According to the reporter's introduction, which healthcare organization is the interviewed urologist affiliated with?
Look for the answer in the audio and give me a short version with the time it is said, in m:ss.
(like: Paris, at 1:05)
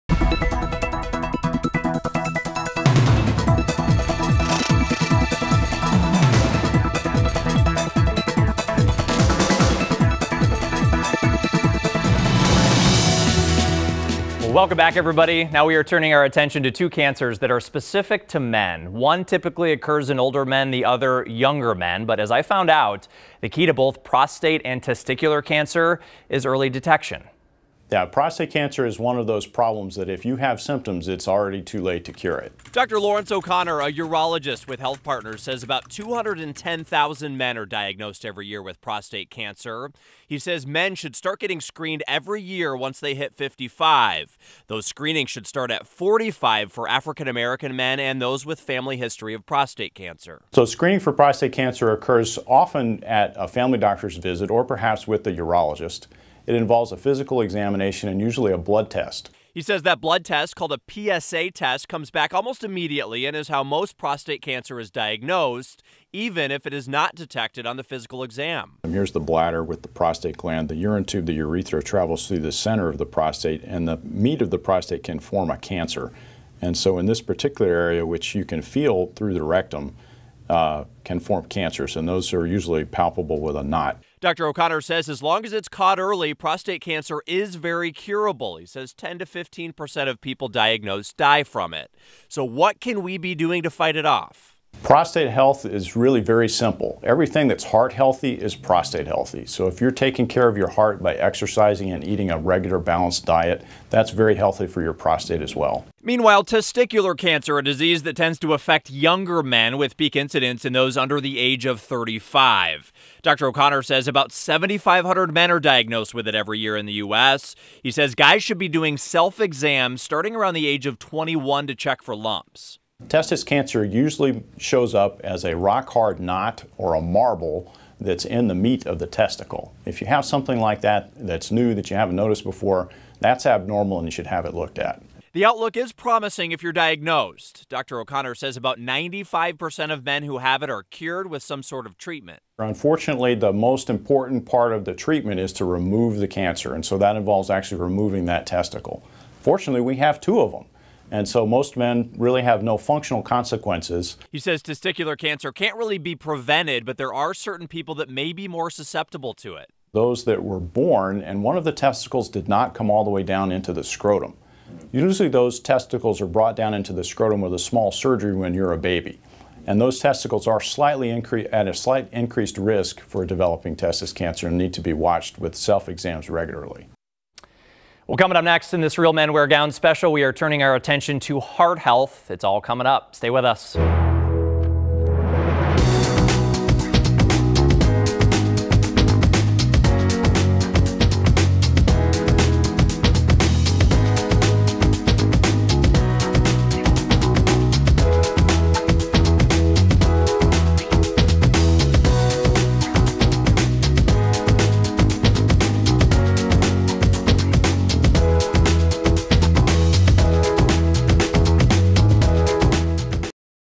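Health Partners, at 0:34.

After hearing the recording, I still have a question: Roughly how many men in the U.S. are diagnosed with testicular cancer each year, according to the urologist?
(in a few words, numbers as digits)
7,500.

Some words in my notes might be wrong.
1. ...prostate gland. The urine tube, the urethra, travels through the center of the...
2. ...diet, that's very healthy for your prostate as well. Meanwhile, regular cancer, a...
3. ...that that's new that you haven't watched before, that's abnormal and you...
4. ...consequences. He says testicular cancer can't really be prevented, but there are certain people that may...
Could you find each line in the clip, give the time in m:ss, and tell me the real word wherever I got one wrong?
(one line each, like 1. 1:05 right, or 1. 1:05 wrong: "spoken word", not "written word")
1. 1:09 right
2. 1:43 wrong: "testicular", not "regular"
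3. 2:10 wrong: "noticed", not "watched"
4. 2:33 right.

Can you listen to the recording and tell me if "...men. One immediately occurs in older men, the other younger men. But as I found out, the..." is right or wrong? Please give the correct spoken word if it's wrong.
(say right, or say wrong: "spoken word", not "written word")
wrong: "typically", not "immediately".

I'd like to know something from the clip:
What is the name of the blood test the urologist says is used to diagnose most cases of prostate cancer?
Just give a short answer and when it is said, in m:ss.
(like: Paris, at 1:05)
PSA test, at 1:01.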